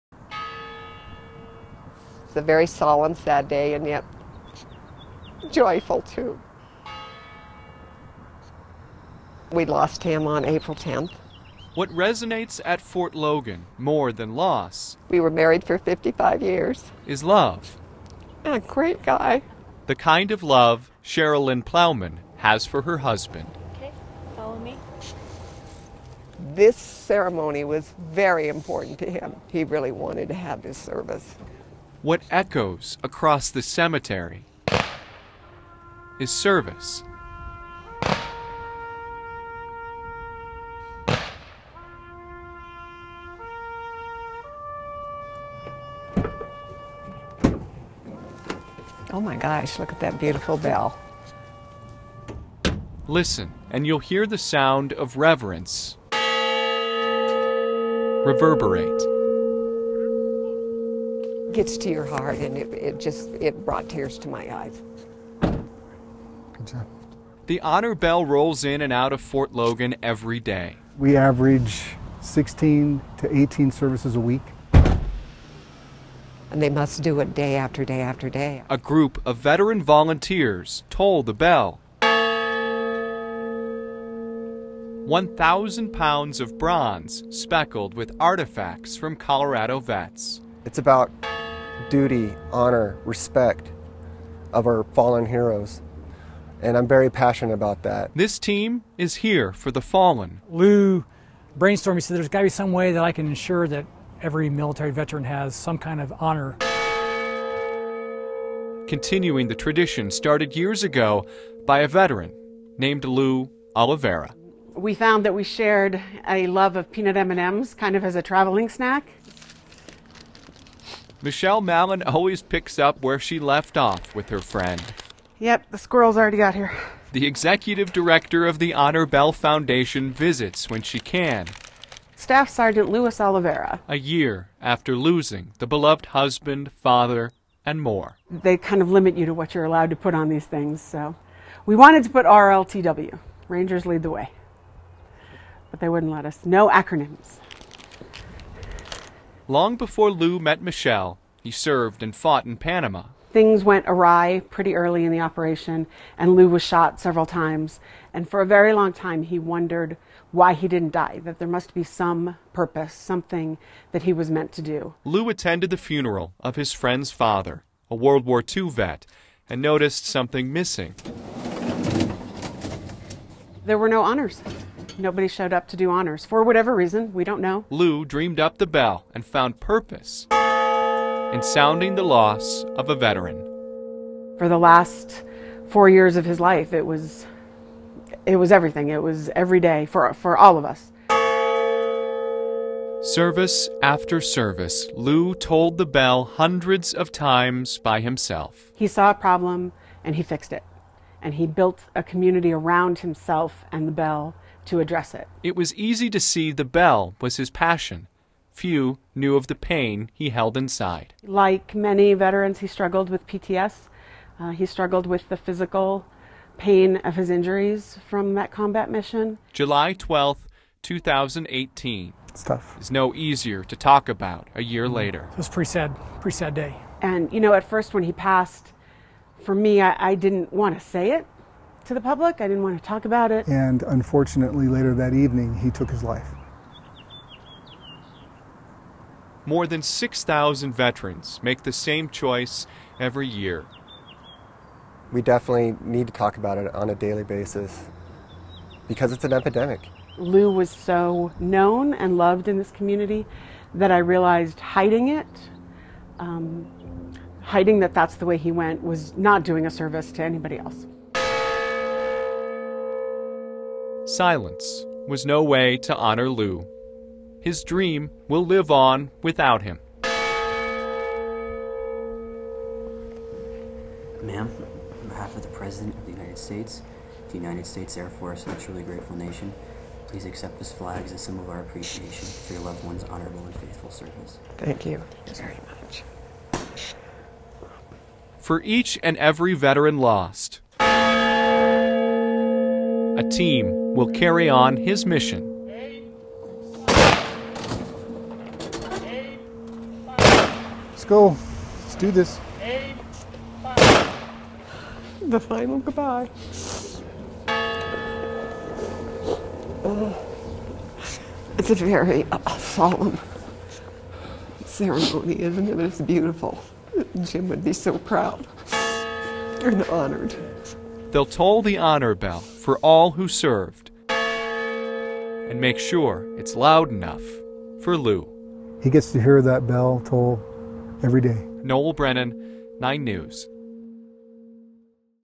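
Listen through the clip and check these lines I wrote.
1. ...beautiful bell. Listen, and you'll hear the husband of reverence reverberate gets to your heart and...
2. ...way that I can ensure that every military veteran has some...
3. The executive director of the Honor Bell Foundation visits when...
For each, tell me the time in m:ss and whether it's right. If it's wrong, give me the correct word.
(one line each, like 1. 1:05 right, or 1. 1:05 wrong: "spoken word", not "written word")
1. 0:50 wrong: "sound", not "husband"
2. 1:42 right
3. 2:07 right.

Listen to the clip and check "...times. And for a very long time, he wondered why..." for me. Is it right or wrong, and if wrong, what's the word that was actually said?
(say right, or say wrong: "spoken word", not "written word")
right.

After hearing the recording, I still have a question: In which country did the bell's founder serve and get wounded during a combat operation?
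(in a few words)
Panama.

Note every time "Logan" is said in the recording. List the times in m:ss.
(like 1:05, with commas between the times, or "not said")
0:13, 1:09.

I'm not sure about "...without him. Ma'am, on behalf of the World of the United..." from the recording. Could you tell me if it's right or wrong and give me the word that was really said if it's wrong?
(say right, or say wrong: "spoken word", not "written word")
wrong: "President", not "World".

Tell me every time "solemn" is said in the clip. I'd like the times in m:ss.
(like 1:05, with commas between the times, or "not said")
0:02, 5:12.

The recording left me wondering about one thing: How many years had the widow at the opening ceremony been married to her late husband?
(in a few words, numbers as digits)
55.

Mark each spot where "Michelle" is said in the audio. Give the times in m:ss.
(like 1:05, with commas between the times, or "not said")
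2:01, 2:30.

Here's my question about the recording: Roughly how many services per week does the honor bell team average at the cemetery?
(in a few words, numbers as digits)
16 to 18.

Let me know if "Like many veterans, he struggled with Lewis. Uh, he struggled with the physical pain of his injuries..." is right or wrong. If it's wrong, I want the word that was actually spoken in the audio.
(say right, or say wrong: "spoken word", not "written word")
wrong: "PTS", not "Lewis".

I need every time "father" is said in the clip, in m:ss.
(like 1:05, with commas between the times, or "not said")
2:16, 2:47.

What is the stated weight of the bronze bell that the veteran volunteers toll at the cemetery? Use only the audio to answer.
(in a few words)
1,000 pounds.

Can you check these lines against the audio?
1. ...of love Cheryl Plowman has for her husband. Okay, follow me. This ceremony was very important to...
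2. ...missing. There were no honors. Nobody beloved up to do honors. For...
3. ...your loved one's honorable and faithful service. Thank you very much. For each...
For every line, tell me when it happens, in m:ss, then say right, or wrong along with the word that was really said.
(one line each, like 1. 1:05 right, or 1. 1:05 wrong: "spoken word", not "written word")
1. 0:20 right
2. 2:50 wrong: "showed", not "beloved"
3. 4:42 right.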